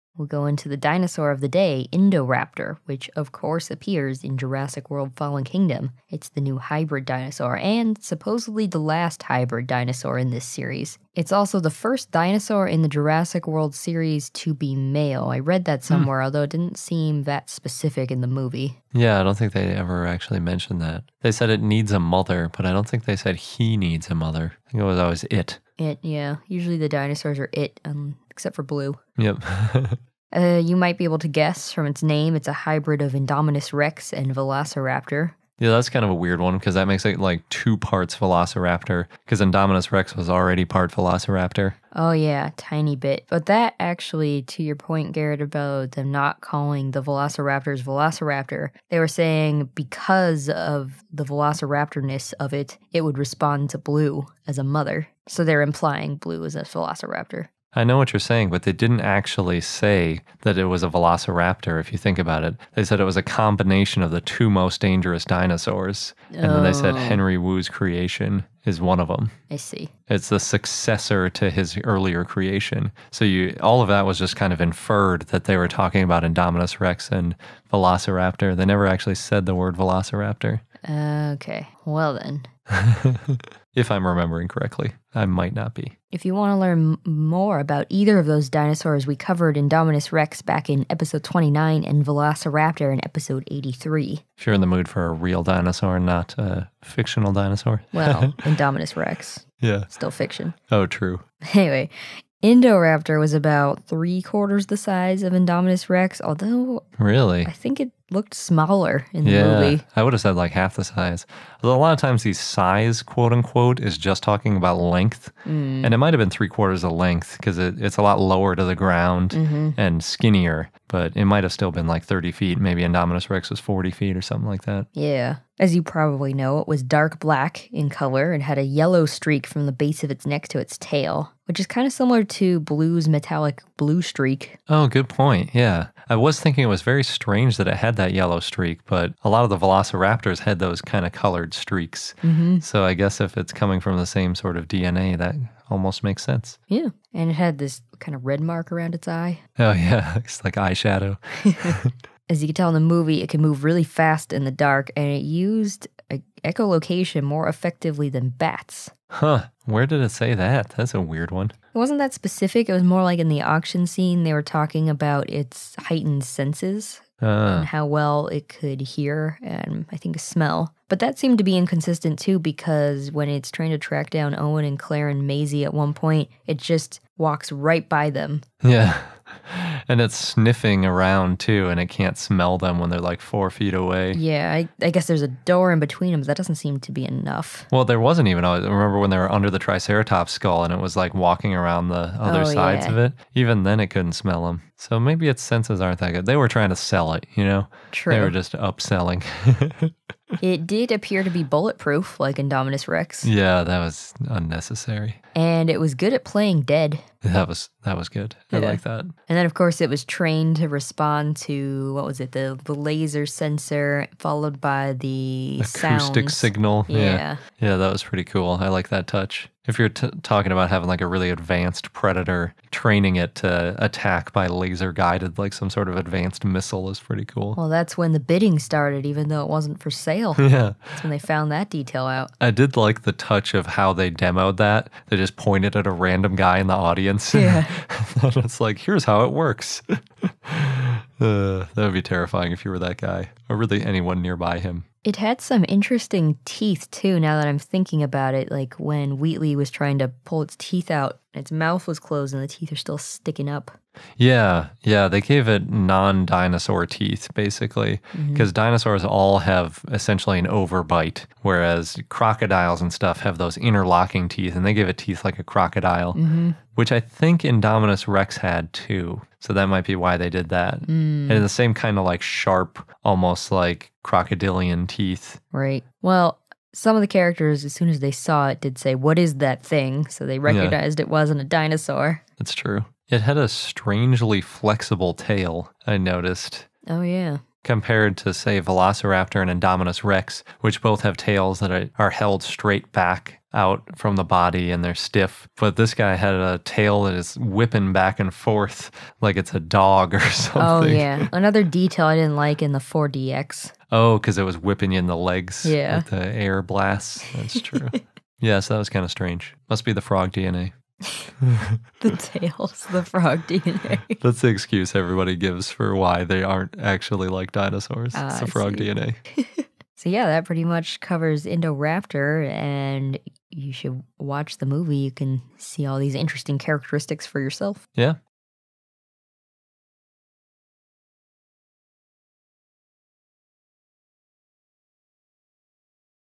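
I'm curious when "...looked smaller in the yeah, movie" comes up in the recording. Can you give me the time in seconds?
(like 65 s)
108 s.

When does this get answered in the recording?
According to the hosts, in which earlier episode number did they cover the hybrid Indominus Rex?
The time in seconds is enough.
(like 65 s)
90 s.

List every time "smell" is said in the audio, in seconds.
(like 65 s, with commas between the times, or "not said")
170 s, 182 s, 194 s.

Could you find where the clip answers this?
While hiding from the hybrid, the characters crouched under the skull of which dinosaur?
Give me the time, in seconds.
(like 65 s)
189 s.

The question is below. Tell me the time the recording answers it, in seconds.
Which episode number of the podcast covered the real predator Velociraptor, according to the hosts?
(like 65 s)
93 s.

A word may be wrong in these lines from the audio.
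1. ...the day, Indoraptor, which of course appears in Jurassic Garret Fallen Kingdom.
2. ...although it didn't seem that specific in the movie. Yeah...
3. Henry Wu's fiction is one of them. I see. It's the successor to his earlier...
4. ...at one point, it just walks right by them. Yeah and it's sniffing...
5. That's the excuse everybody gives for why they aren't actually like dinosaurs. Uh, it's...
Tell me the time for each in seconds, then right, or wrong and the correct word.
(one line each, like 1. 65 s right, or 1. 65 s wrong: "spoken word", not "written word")
1. 1 s wrong: "World", not "Garret"
2. 16 s right
3. 66 s wrong: "creation", not "fiction"
4. 175 s right
5. 314 s right.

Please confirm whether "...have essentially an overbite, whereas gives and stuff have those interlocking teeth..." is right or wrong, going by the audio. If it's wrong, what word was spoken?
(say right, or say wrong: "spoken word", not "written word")
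wrong: "crocodiles", not "gives".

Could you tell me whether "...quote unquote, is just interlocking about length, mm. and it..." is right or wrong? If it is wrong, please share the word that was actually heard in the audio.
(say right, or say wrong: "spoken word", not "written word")
wrong: "talking", not "interlocking".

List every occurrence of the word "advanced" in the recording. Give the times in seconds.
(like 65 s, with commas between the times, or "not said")
221 s, 225 s.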